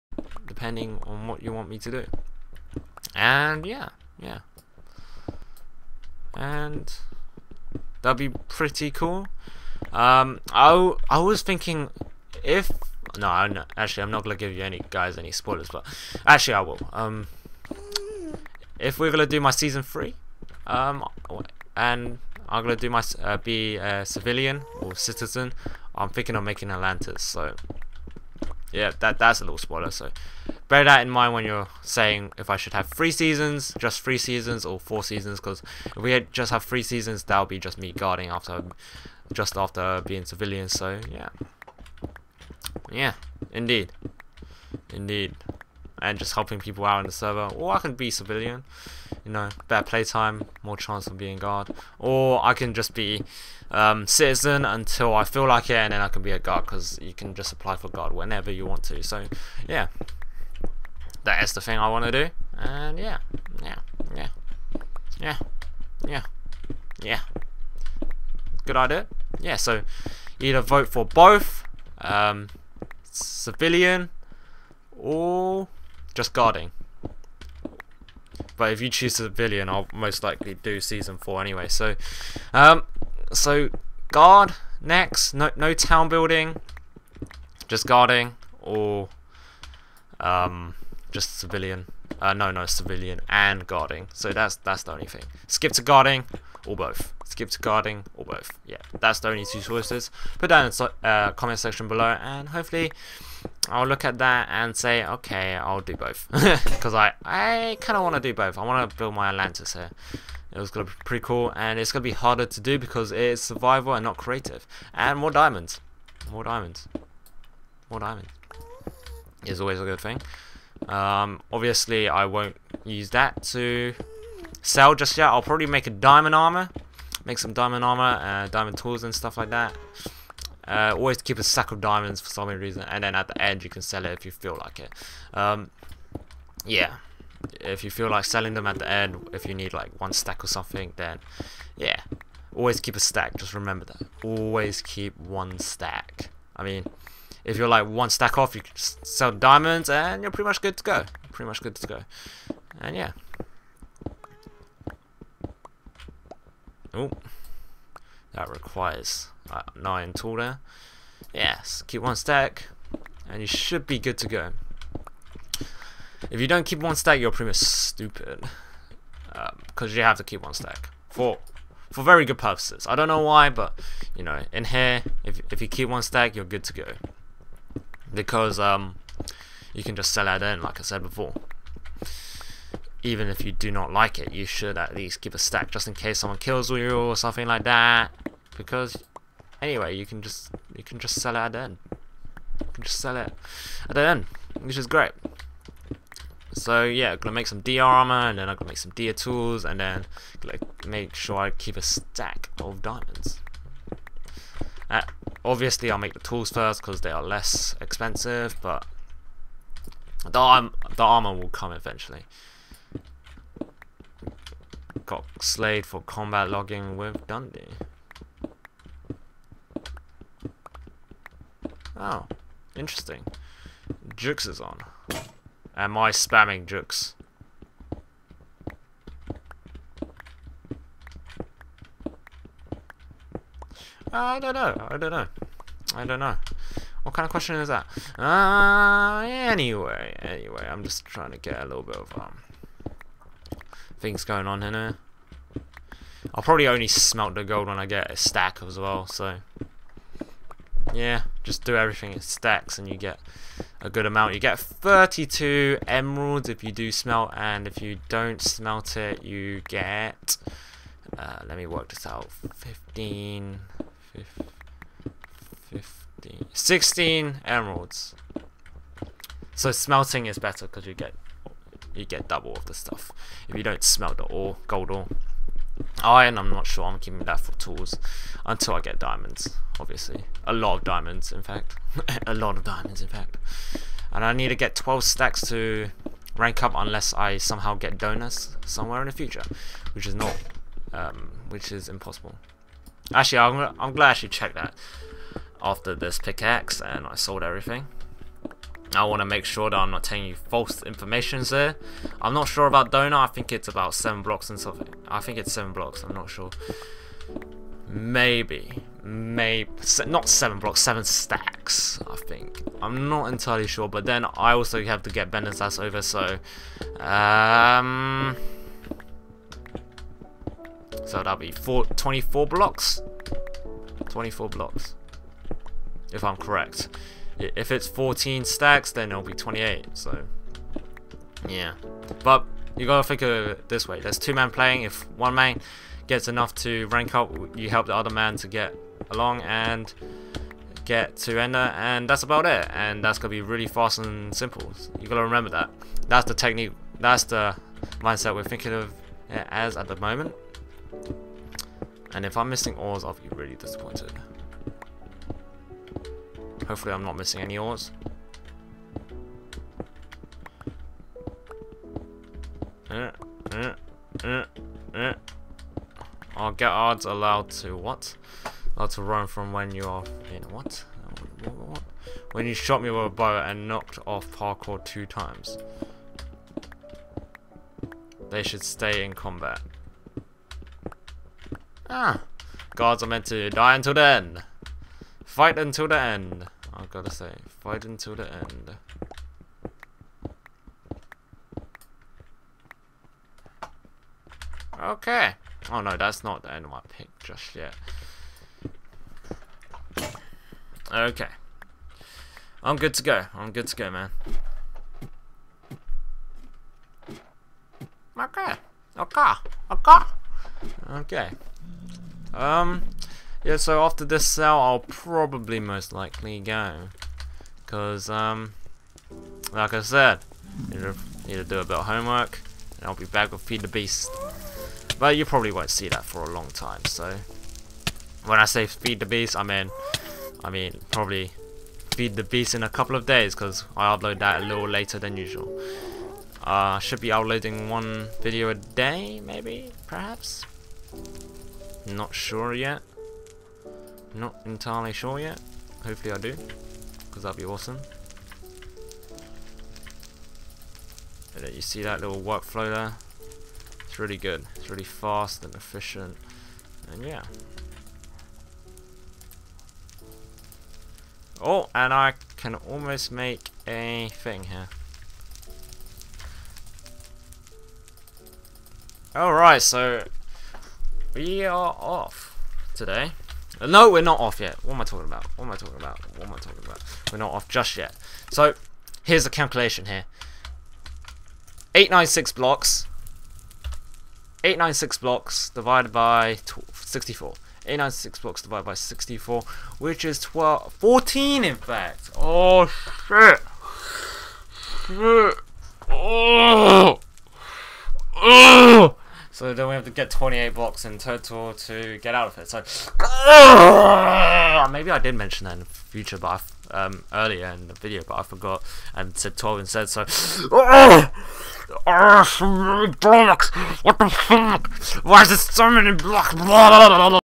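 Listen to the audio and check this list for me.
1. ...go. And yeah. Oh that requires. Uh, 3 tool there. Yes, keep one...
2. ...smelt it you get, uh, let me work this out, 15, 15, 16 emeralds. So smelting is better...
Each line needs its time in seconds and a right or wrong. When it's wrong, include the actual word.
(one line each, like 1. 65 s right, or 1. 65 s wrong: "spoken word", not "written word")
1. 151 s wrong: "9", not "3"
2. 258 s right.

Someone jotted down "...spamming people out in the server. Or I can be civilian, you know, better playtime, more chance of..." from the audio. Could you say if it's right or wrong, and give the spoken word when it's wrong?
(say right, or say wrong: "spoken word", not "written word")
wrong: "helping", not "spamming".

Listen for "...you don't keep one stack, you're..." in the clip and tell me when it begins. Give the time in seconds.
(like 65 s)
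166 s.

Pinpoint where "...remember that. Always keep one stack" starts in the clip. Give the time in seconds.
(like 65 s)
143 s.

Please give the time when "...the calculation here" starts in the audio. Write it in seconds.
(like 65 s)
479 s.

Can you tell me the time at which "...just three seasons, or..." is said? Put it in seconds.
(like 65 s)
33 s.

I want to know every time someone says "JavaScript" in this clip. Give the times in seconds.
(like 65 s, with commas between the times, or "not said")
not said.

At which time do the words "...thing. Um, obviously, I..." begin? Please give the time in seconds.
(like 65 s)
120 s.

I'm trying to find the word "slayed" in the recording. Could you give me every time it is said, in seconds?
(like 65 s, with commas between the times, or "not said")
215 s.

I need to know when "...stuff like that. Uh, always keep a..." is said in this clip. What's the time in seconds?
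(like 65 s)
129 s.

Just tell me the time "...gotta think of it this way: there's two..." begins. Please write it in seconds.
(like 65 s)
332 s.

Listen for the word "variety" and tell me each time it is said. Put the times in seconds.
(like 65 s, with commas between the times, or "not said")
not said.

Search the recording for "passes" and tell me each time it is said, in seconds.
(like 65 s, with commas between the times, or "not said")
not said.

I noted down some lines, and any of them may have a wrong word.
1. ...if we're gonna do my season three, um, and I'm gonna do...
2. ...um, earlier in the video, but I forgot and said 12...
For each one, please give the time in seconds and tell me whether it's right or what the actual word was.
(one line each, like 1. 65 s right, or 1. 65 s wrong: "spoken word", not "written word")
1. 18 s right
2. 506 s right.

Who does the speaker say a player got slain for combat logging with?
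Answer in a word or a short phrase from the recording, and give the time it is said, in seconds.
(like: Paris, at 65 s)
Dundee, at 217 s.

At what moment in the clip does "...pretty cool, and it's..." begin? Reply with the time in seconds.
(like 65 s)
111 s.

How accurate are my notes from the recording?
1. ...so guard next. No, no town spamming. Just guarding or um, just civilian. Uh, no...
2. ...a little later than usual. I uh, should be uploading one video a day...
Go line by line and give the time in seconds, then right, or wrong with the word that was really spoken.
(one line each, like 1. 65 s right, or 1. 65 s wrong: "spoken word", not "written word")
1. 83 s wrong: "building", not "spamming"
2. 434 s right.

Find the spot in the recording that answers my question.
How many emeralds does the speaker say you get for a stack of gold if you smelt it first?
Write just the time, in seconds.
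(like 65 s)
254 s.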